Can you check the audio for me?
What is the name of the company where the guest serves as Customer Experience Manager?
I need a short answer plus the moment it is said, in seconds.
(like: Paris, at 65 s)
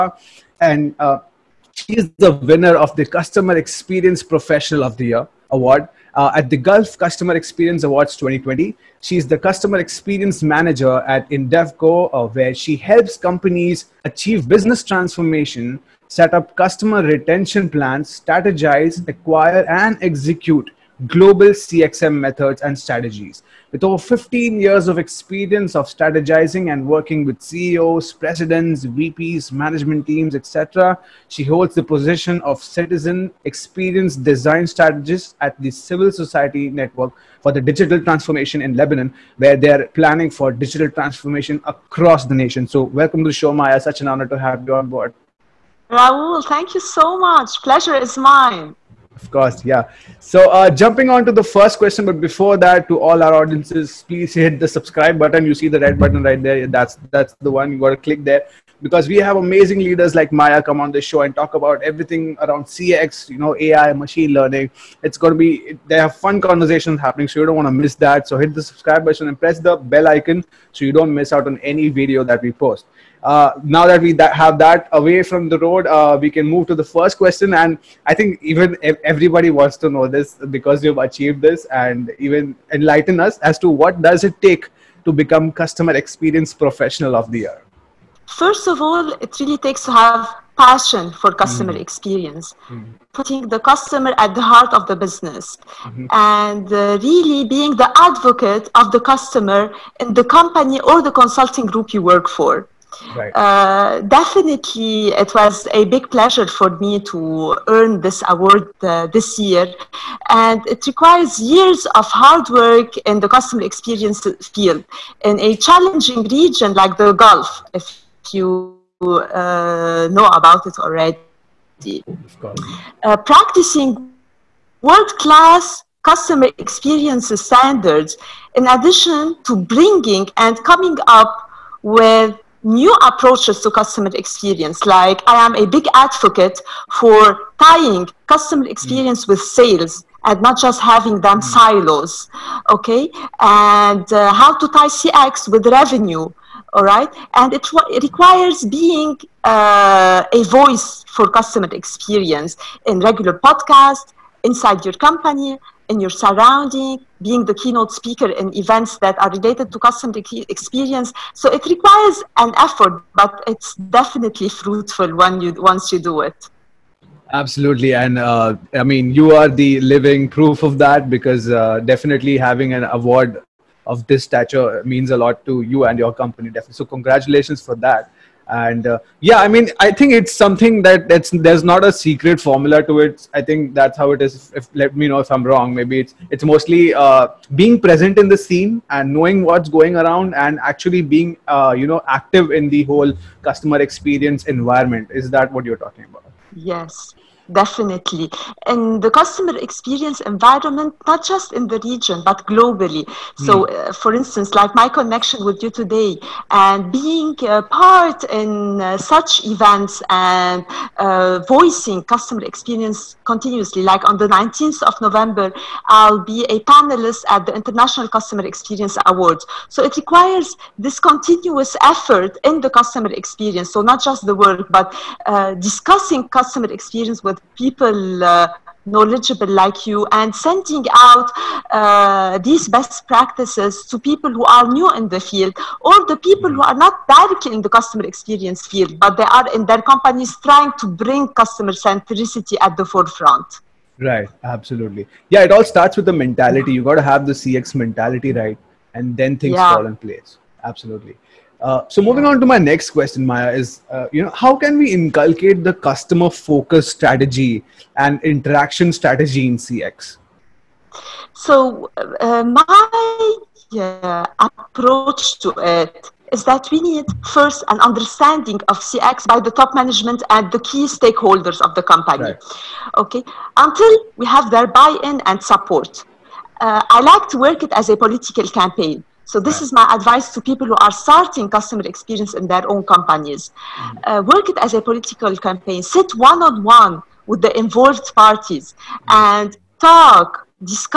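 Indevco, at 11 s.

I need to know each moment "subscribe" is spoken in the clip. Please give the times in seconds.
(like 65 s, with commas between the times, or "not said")
54 s, 68 s.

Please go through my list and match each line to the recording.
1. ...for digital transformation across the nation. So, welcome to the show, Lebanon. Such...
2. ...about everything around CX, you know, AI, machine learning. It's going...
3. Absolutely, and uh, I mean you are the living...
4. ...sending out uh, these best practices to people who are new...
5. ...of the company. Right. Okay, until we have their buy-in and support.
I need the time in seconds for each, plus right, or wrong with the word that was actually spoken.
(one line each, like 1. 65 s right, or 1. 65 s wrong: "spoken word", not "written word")
1. 40 s wrong: "Maya", not "Lebanon"
2. 61 s right
3. 167 s right
4. 230 s right
5. 271 s right.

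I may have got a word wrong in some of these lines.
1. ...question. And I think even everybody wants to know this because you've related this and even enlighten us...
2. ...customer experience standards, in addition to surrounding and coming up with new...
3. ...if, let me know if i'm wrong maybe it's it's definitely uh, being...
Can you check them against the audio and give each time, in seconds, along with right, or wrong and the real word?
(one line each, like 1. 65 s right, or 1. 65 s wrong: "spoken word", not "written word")
1. 77 s wrong: "achieved", not "related"
2. 126 s wrong: "bringing", not "surrounding"
3. 184 s wrong: "mostly", not "definitely".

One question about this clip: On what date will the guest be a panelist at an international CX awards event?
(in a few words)
19th of November.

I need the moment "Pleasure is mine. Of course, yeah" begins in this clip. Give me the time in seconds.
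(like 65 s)
47 s.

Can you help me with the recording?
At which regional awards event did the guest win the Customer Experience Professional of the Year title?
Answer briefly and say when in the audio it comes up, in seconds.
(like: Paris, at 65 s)
Gulf Customer Experience Awards 2020, at 6 s.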